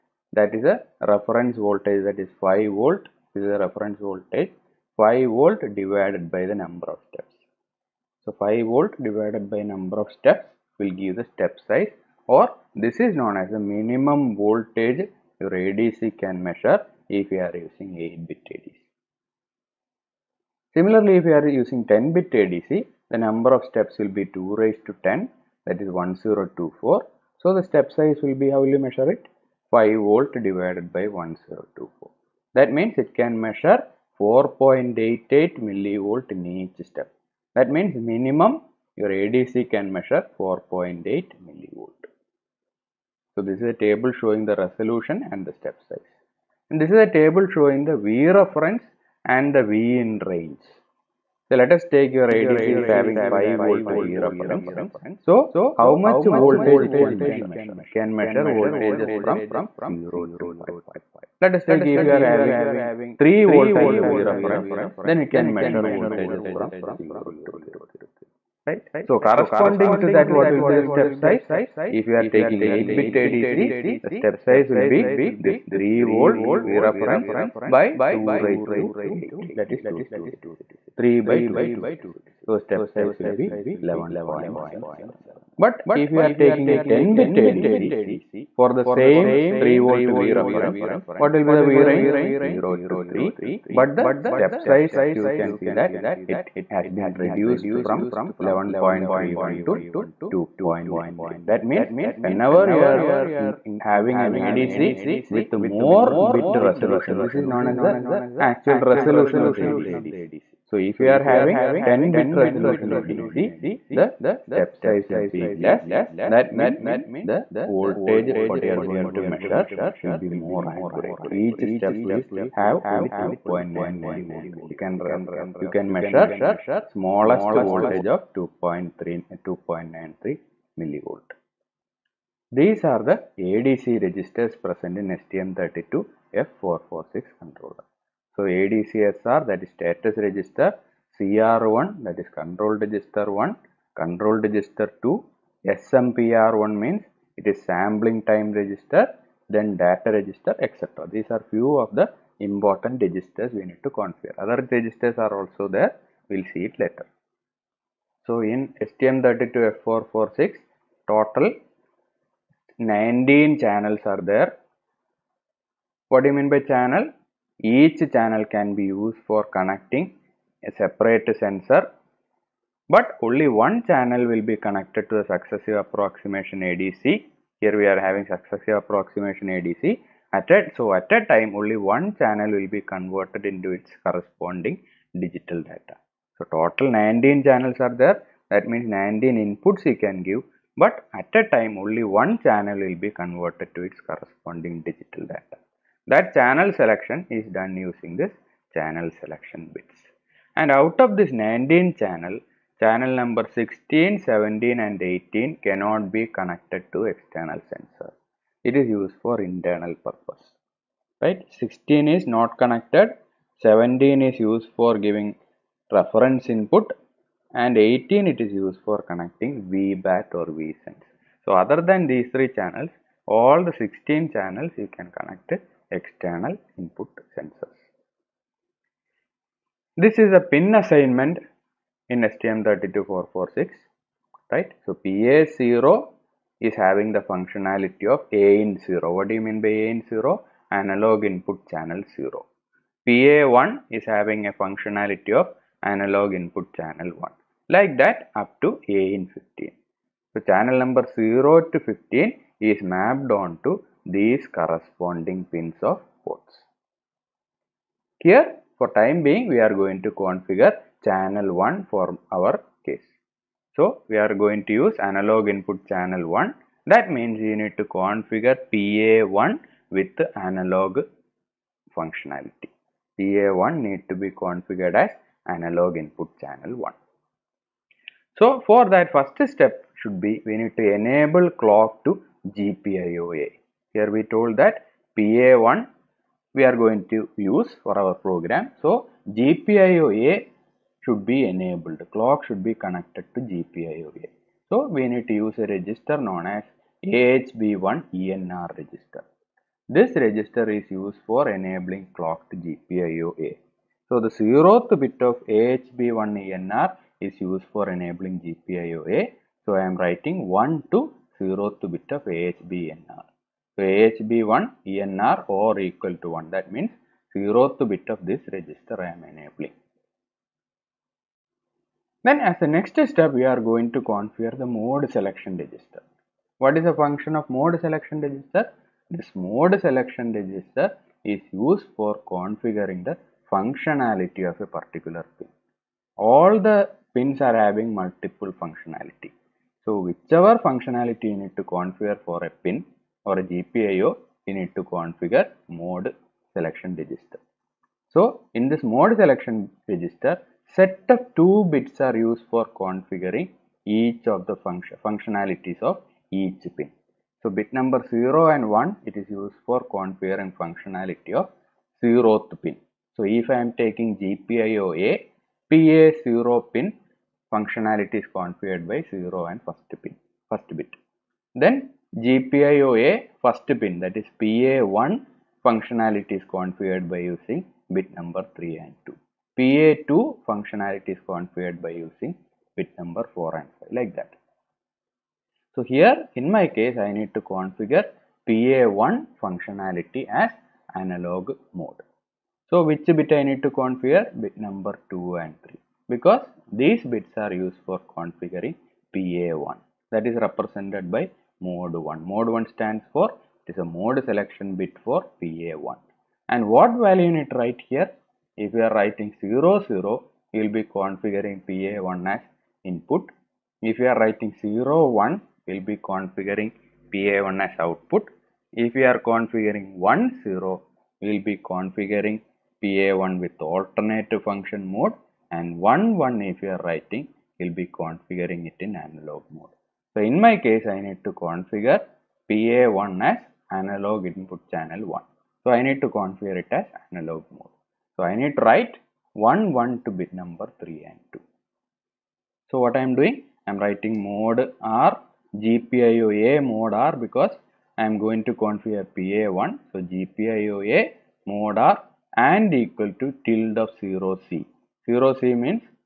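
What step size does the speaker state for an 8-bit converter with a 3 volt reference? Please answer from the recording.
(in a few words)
11.71.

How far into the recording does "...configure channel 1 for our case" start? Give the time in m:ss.
4:20.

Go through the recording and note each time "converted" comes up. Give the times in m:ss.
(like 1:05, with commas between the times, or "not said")
3:02, 3:13.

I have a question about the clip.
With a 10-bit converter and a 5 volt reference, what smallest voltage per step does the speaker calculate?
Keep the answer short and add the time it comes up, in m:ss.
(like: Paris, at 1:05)
4.88 millivolt, at 0:34.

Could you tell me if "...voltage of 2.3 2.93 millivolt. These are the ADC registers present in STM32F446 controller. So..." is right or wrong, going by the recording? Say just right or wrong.
right.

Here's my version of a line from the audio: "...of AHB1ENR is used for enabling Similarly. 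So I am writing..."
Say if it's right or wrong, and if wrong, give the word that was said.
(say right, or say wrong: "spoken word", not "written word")
wrong: "GPIOA", not "Similarly".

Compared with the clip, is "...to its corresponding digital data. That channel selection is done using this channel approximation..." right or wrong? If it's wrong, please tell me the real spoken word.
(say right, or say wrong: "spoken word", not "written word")
wrong: "selection", not "approximation".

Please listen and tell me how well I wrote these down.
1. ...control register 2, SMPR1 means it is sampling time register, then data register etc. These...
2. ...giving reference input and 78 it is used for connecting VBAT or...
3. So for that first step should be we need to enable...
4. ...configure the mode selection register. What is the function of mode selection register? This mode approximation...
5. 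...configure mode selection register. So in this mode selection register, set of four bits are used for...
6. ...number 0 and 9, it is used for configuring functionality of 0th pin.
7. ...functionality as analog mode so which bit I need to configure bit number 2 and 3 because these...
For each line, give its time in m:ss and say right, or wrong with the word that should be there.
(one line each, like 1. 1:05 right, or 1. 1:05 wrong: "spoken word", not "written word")
1. 2:23 right
2. 3:34 wrong: "18", not "78"
3. 4:38 right
4. 5:24 wrong: "selection", not "approximation"
5. 5:44 wrong: "two", not "four"
6. 5:57 wrong: "1", not "9"
7. 6:29 right.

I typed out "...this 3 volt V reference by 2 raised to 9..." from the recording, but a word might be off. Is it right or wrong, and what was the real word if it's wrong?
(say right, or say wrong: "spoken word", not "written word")
wrong: "8", not "9".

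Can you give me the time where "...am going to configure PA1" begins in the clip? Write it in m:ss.
7:28.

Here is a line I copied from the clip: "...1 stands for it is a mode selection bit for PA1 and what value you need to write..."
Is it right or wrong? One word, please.
right.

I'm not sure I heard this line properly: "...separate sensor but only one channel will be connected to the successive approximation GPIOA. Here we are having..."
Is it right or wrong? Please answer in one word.
wrong.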